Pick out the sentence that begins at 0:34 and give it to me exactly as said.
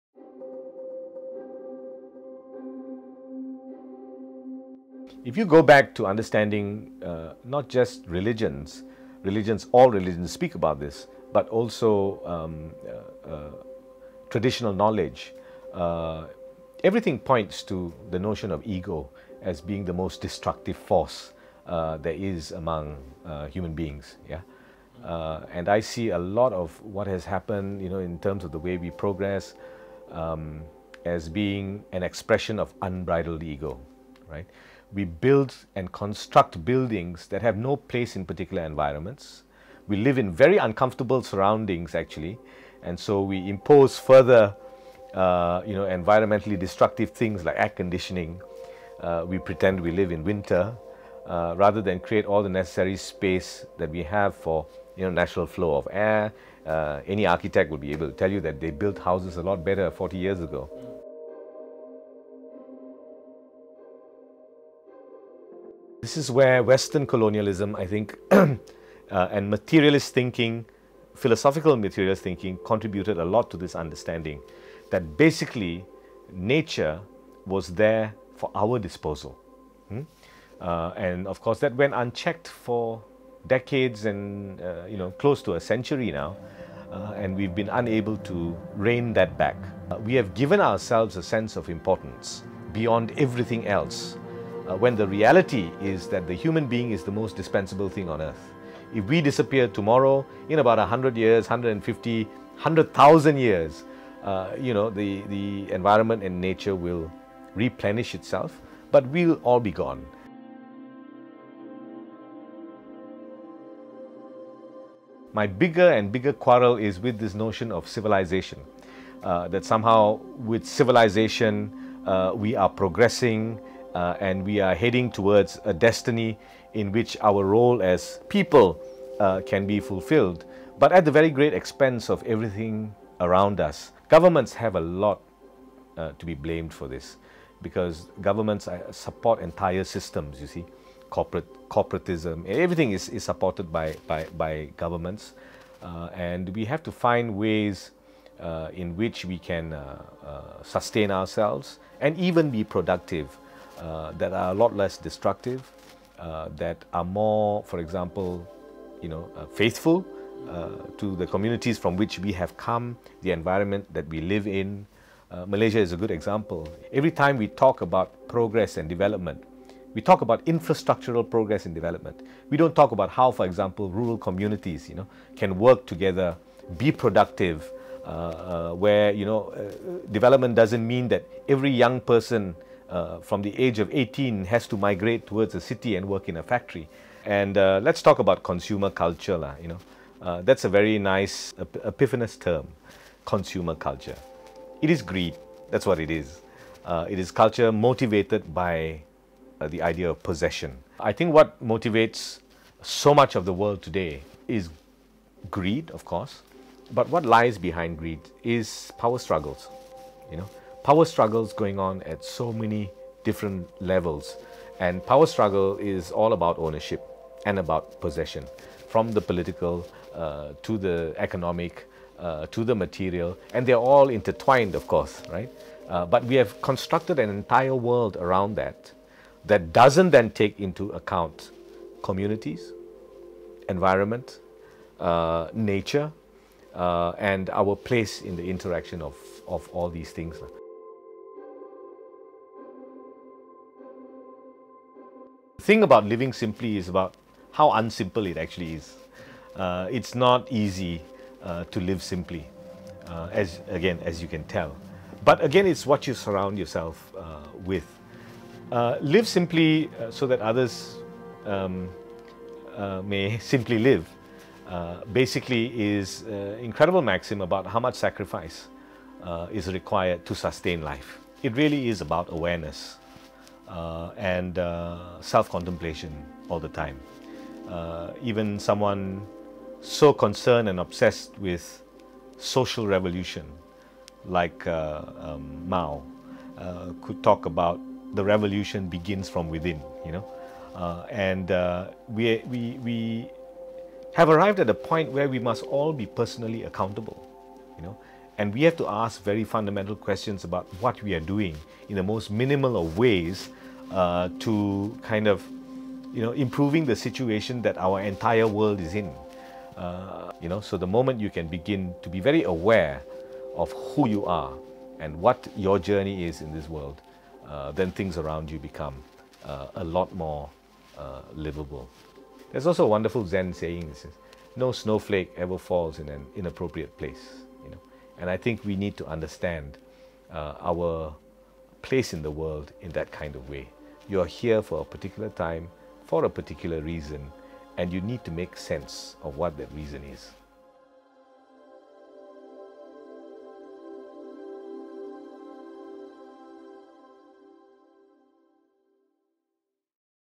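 we build and construct buildings that have no place in particular environments.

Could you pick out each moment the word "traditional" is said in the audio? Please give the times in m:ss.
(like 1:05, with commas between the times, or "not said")
0:14.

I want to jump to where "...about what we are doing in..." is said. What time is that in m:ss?
5:00.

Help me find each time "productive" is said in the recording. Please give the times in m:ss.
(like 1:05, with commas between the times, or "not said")
2:32, 2:56.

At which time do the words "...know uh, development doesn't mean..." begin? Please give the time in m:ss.
2:59.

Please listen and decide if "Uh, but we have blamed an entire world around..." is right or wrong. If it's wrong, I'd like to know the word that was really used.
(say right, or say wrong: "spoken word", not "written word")
wrong: "constructed", not "blamed".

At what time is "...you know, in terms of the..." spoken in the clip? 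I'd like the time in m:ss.
0:27.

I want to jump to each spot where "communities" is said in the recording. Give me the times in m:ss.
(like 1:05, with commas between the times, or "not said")
2:41, 2:54, 3:52.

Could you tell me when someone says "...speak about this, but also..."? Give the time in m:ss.
0:10.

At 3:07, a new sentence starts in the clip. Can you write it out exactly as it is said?
And uh, let's talk about consumer culture, lah, you know.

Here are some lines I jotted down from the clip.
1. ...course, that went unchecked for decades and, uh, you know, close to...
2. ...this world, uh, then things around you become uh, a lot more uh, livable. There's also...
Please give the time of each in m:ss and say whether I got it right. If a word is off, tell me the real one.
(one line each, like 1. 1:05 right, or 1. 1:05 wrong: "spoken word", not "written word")
1. 1:21 right
2. 5:16 right.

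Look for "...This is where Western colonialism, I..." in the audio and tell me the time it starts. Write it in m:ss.
1:06.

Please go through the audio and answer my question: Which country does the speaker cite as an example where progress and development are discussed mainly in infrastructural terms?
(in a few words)
Malaysia.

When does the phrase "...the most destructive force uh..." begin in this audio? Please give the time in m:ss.
0:19.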